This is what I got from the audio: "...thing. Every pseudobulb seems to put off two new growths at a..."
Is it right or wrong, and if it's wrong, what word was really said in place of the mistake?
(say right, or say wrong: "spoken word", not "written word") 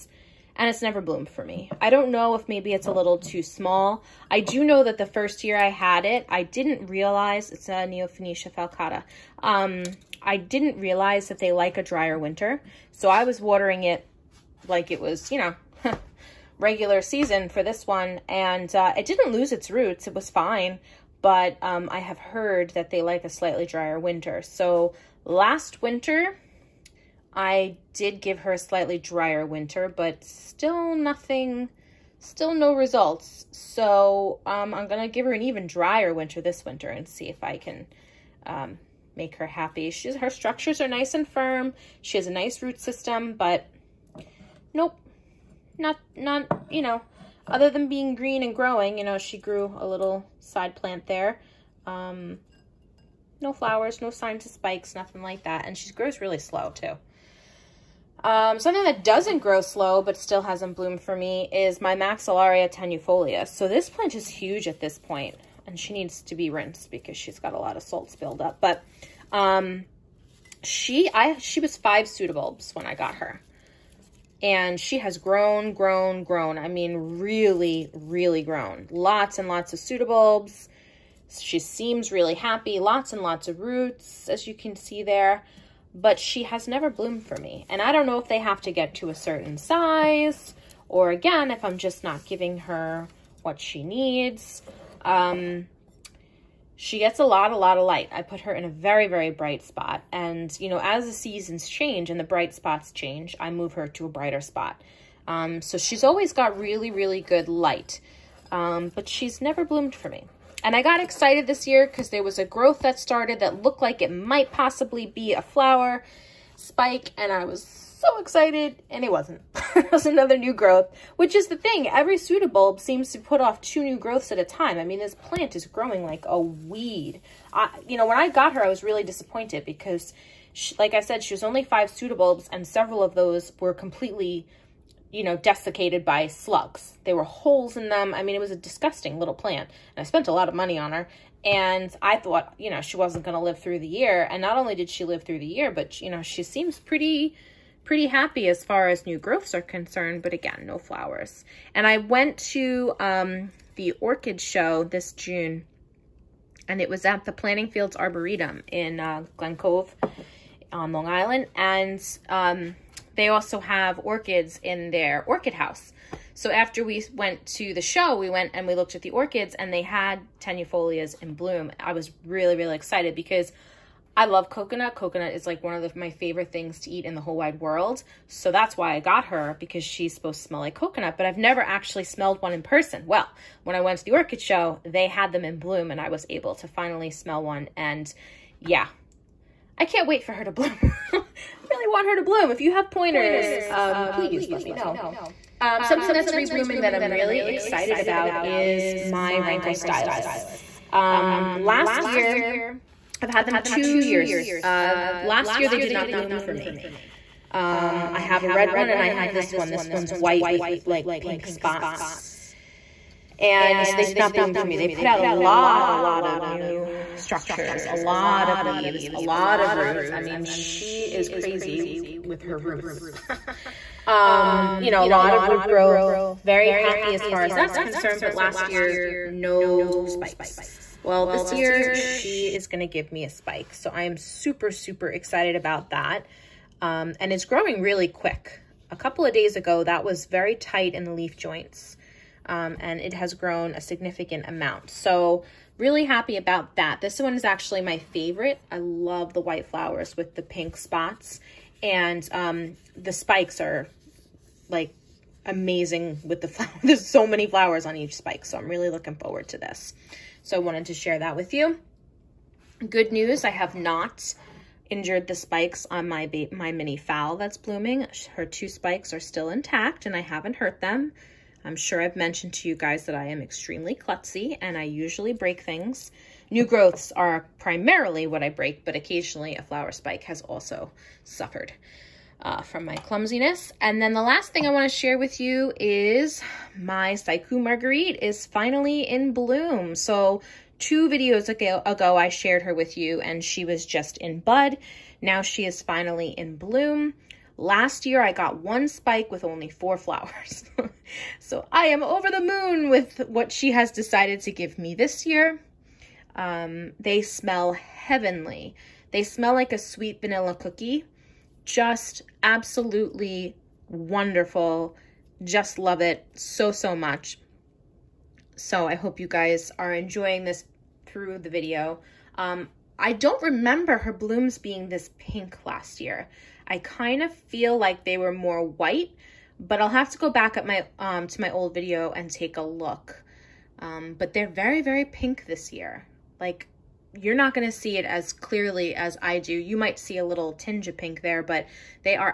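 right.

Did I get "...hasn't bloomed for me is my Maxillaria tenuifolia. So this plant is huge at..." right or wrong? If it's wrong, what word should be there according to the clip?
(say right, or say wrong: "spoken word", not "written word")
right.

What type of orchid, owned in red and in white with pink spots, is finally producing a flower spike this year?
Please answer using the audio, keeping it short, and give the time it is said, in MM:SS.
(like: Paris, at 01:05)
Rhynchostylis, at 03:19.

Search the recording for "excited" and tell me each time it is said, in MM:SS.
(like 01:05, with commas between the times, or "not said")
01:50, 01:58, 02:52, 03:17, 03:55.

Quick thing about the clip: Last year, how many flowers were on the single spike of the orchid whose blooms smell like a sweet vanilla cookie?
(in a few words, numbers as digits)
4.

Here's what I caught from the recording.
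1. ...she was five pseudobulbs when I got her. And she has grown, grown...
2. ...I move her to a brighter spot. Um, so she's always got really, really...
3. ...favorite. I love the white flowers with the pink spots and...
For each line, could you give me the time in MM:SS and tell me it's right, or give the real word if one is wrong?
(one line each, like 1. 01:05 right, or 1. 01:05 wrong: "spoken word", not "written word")
1. 01:11 right
2. 01:43 right
3. 04:07 right.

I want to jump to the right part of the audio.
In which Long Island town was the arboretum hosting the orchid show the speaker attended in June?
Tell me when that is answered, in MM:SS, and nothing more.
02:39.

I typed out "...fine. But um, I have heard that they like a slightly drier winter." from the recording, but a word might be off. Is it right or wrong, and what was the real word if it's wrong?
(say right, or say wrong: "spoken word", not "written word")
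right.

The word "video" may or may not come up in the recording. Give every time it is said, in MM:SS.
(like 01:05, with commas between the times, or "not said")
04:51, 05:21, 05:31.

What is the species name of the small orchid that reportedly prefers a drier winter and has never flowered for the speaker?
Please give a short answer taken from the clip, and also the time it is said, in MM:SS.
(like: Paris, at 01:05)
Neofinetia falcata, at 00:07.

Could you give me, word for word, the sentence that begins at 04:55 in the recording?
Now she is finally in bloom.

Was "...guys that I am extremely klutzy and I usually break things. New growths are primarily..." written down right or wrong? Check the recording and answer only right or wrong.
right.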